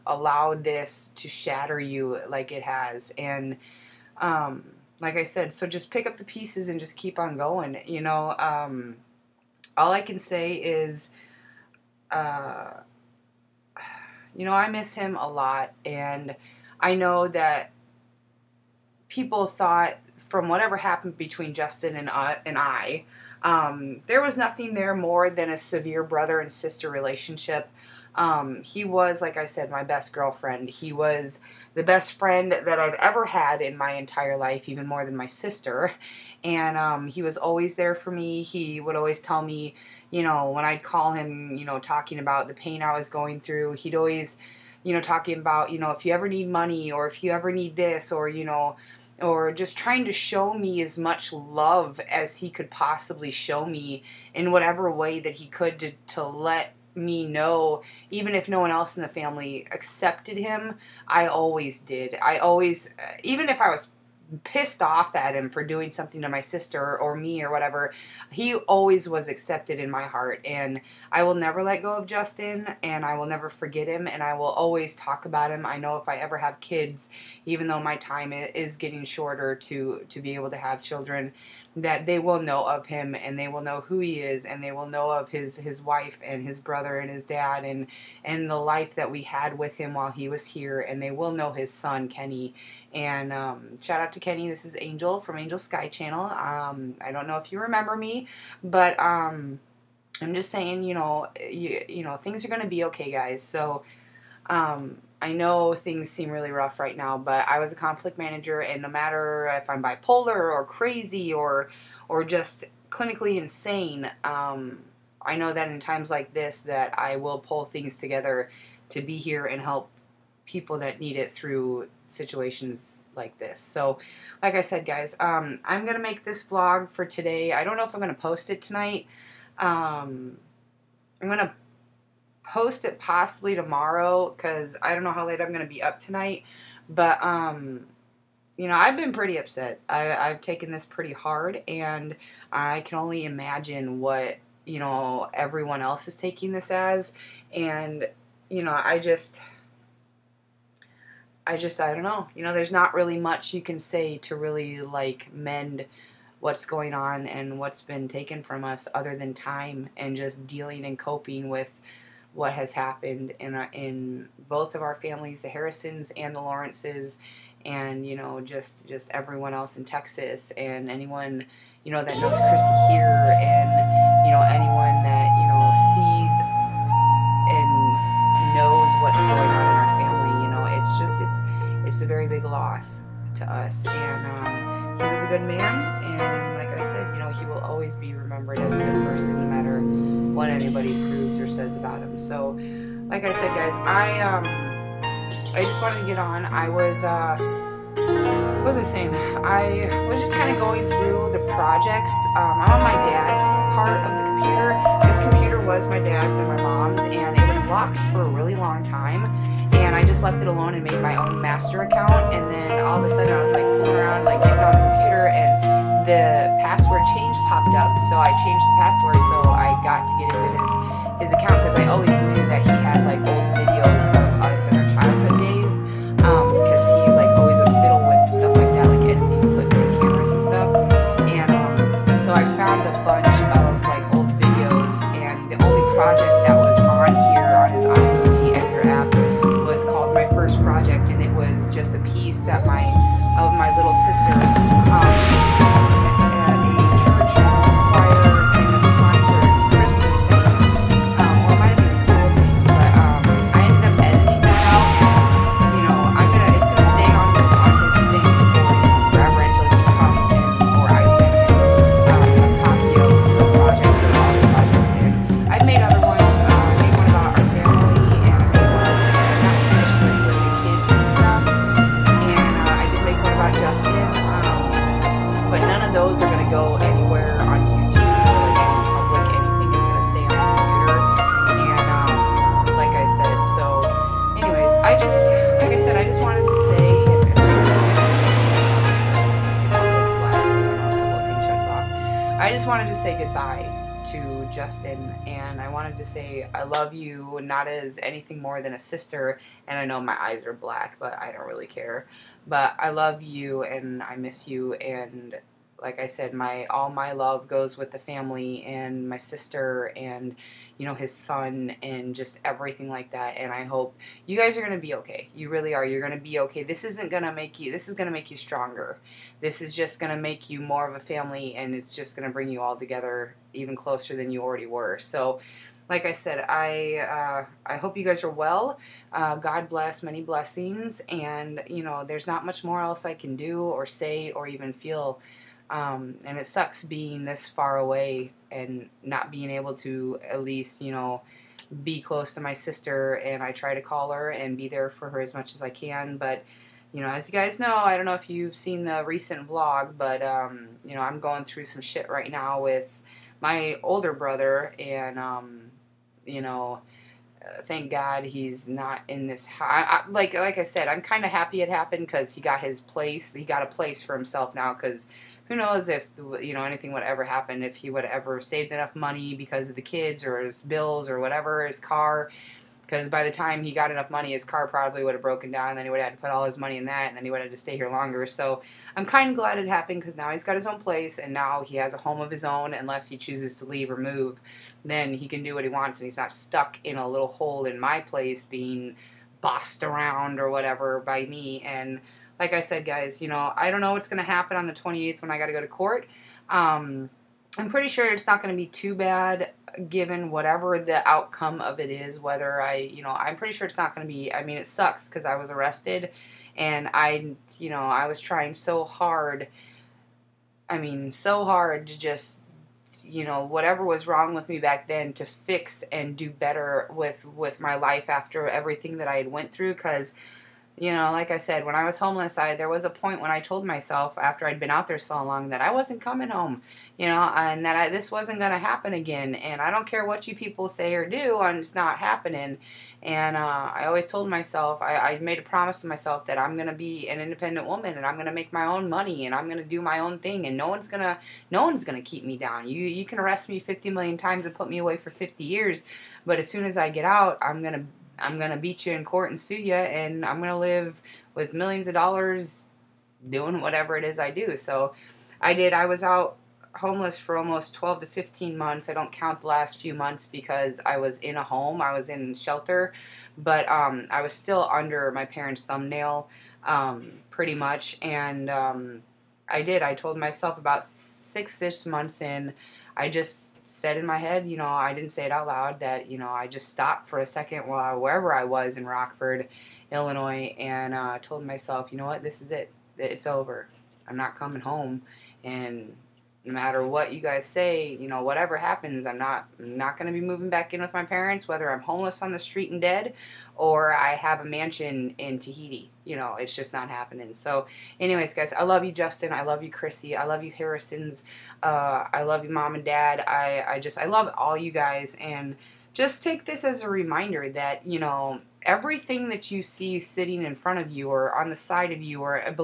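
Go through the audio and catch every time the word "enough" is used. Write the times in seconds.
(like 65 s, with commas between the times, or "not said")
368 s, 373 s.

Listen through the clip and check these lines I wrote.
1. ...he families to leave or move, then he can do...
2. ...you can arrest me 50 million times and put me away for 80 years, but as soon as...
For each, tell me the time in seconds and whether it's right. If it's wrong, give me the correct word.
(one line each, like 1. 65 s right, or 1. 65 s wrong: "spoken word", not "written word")
1. 383 s wrong: "chooses", not "families"
2. 442 s wrong: "50", not "80".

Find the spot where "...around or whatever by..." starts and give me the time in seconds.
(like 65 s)
389 s.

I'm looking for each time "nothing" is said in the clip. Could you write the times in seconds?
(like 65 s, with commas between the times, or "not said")
24 s.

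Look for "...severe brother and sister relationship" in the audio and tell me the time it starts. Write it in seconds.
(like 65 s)
25 s.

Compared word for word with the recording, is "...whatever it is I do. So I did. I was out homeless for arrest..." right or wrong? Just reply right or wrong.
wrong.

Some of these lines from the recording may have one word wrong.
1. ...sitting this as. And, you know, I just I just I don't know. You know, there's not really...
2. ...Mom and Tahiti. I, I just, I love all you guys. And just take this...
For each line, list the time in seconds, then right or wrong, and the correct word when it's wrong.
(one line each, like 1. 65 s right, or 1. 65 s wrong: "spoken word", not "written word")
1. 146 s wrong: "taking", not "sitting"
2. 502 s wrong: "Dad", not "Tahiti".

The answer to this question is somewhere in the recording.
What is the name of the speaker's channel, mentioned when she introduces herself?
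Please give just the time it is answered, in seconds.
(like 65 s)
95 s.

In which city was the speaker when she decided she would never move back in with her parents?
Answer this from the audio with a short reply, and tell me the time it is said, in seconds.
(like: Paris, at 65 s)
Rockford, Illinois, at 478 s.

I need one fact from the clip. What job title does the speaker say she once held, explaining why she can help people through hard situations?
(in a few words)
conflict manager.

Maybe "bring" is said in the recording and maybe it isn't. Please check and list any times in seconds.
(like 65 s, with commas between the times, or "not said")
322 s.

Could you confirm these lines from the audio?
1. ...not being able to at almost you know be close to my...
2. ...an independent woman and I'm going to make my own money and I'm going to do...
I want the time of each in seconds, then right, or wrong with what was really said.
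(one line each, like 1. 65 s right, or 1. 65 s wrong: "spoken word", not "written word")
1. 339 s wrong: "least", not "almost"
2. 437 s right.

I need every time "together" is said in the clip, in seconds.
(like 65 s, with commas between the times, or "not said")
117 s, 322 s.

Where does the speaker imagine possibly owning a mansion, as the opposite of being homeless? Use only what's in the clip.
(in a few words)
Tahiti.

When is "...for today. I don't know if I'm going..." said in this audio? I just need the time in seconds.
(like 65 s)
126 s.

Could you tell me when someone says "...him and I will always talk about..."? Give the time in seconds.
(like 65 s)
73 s.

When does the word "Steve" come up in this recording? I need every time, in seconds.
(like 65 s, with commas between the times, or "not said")
not said.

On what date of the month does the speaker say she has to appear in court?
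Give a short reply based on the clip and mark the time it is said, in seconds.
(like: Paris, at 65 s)
28th, at 394 s.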